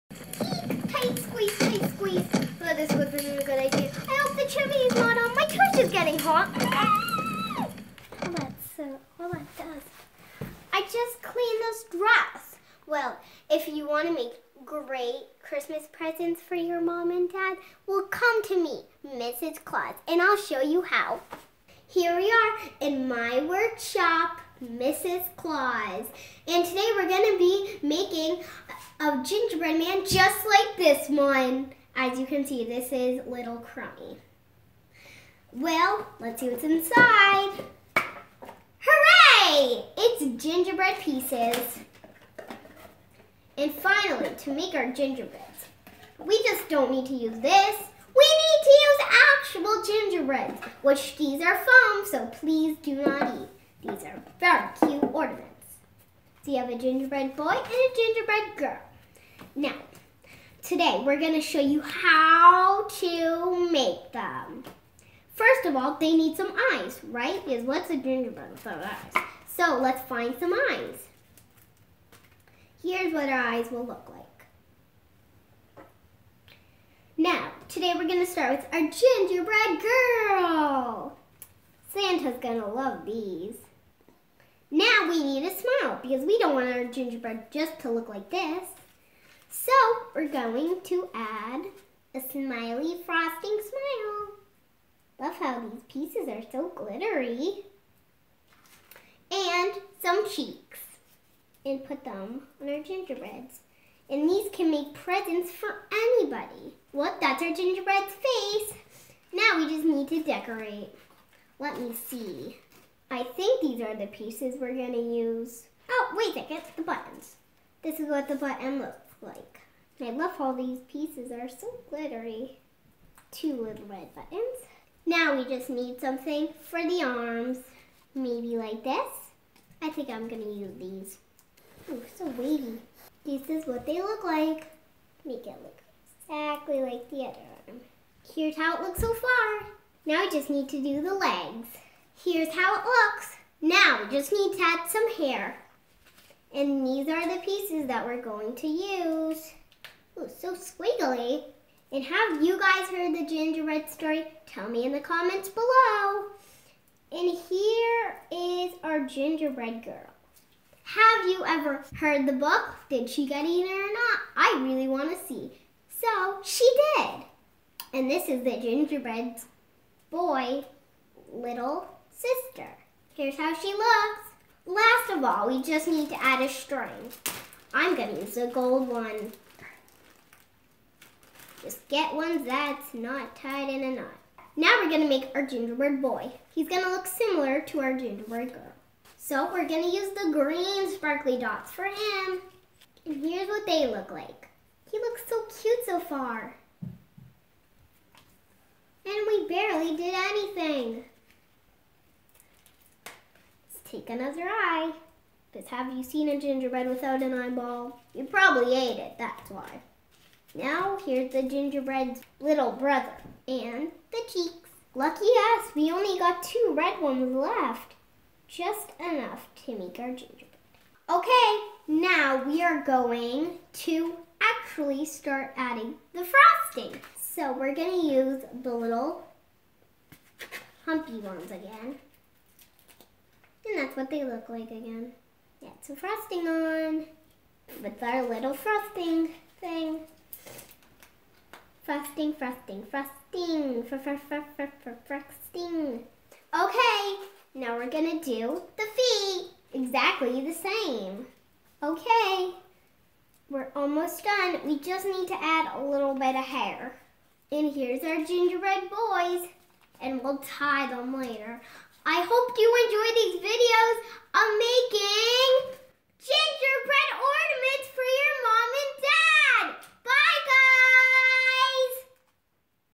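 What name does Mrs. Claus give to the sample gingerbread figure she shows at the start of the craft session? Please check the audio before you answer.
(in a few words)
Little Crummy.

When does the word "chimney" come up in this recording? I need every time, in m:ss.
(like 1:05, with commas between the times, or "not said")
0:04.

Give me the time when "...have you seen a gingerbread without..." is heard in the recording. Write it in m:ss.
3:25.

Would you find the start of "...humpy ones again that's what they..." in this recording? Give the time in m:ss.
3:50.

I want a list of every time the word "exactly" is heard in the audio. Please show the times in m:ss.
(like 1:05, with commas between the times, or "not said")
2:16, 4:09.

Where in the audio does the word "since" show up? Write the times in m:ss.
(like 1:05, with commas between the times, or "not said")
not said.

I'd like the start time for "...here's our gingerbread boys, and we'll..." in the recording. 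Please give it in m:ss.
4:17.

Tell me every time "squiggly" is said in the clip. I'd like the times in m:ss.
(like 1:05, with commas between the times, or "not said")
2:30.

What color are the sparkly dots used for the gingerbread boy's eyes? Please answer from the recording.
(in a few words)
Green.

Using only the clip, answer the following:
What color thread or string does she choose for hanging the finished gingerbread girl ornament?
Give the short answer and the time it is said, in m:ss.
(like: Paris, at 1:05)
Gold, at 2:58.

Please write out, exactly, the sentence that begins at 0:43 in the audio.
And finally, to make our gingerbread, we just don't need to use this.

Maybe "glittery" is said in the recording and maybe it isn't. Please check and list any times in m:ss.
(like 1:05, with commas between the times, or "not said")
1:36, 2:01.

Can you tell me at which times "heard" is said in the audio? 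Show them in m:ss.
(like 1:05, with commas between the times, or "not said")
2:32, 2:41.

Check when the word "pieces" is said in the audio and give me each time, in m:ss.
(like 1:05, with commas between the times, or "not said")
0:40, 1:35, 1:54, 2:00, 2:27.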